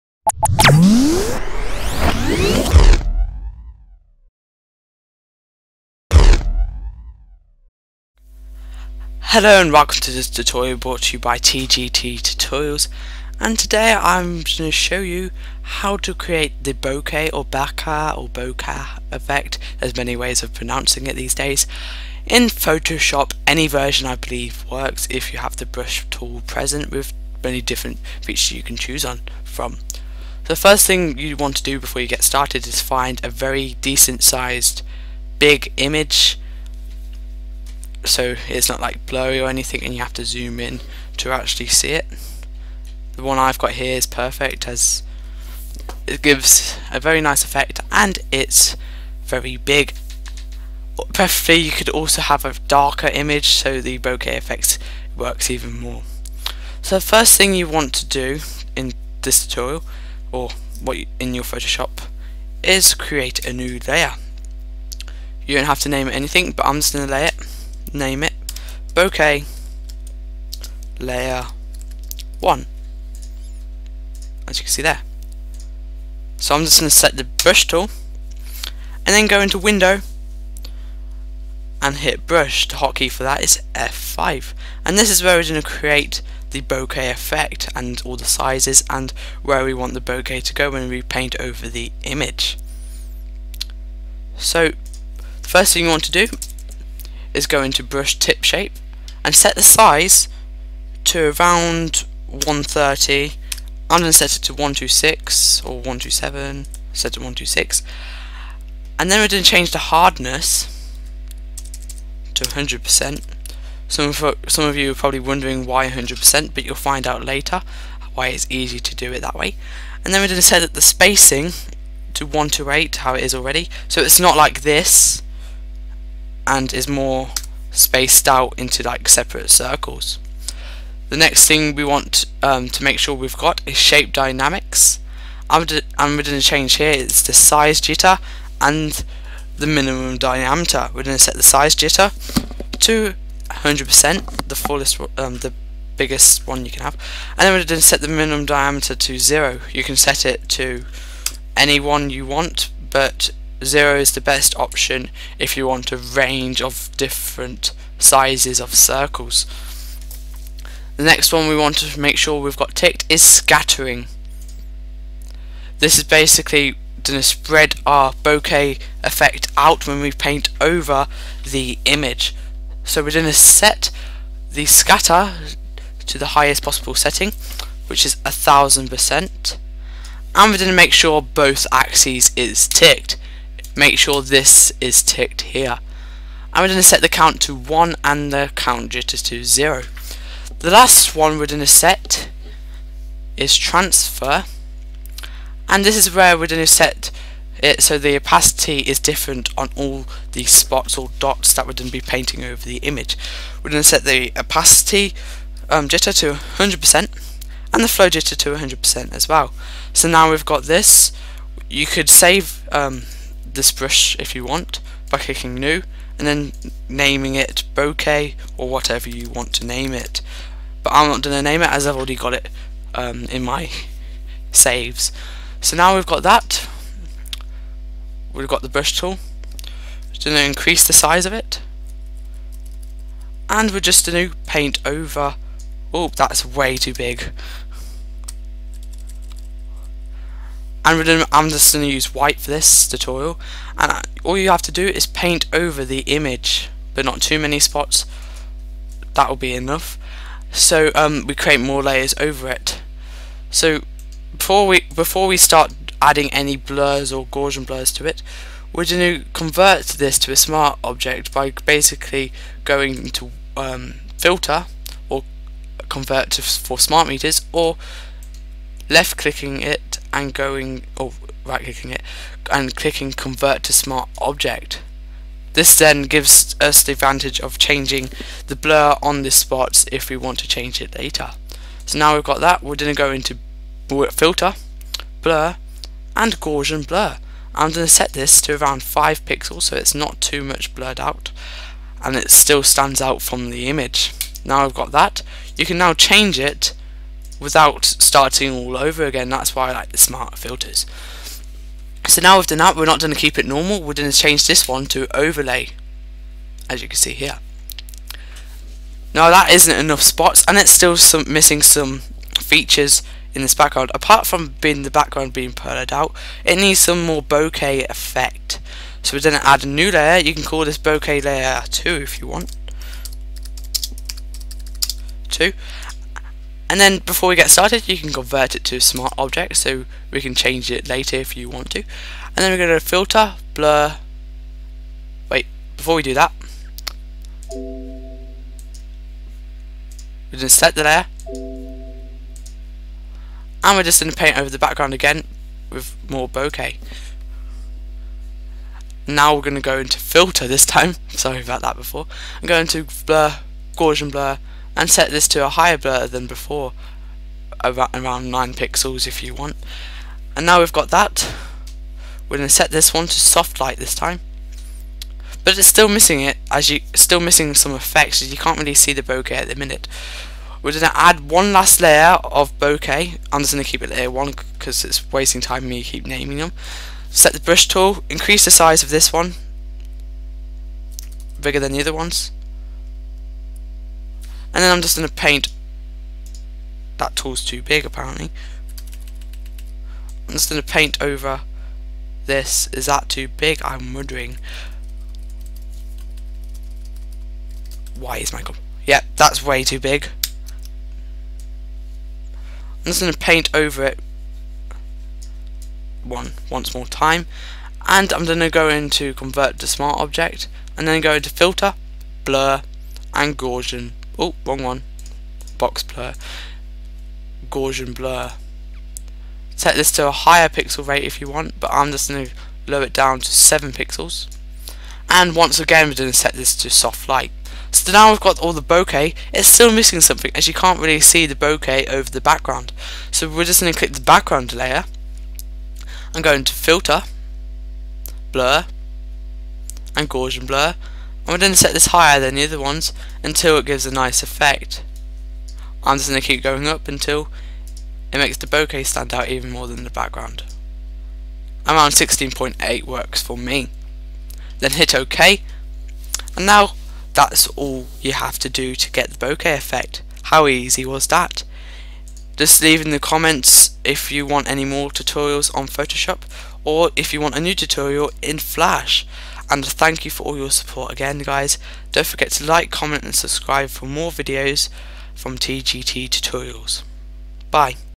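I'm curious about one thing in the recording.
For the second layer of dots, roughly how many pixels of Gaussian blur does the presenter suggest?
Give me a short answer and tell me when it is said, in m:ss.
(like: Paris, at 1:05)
9 pixels, at 5:58.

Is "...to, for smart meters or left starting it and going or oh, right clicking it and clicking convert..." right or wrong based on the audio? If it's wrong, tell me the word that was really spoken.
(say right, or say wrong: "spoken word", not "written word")
wrong: "clicking", not "starting".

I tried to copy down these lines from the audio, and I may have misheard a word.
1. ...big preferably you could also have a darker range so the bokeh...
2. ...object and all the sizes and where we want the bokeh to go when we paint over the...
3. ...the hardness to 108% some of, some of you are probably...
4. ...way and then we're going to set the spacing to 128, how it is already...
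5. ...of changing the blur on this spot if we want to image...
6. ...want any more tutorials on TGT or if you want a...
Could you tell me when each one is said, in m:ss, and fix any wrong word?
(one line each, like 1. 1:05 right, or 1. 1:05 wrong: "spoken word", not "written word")
1. 0:49 wrong: "image", not "range"
2. 1:27 wrong: "effect", not "object"
3. 1:49 wrong: "100", not "108"
4. 1:59 right
5. 4:37 wrong: "change", not "image"
6. 7:44 wrong: "Photoshop", not "TGT".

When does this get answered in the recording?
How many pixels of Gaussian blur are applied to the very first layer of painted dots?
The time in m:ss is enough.
4:48.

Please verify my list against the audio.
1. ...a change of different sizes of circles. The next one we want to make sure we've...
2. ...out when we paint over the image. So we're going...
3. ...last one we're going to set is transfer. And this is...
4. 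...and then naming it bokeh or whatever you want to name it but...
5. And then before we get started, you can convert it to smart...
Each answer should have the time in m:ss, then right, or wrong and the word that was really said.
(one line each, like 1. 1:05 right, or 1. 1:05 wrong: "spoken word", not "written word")
1. 2:35 wrong: "range", not "change"
2. 2:49 right
3. 3:10 right
4. 3:36 right
5. 5:26 right.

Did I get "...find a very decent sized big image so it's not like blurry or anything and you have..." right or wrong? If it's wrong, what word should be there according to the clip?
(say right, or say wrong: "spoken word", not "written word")
right.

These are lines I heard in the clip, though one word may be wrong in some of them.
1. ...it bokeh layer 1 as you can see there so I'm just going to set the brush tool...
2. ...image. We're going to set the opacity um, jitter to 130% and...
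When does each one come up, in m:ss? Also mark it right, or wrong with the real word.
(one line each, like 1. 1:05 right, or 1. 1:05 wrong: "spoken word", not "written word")
1. 1:08 right
2. 3:22 wrong: "100", not "130".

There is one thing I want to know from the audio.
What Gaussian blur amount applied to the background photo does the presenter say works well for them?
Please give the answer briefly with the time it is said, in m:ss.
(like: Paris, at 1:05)
16.8, at 7:31.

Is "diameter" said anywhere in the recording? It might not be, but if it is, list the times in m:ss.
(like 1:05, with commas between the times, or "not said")
2:20, 2:28.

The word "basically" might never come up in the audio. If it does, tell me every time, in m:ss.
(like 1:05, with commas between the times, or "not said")
2:46, 4:21.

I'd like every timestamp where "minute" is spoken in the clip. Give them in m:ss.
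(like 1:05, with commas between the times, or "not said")
6:09.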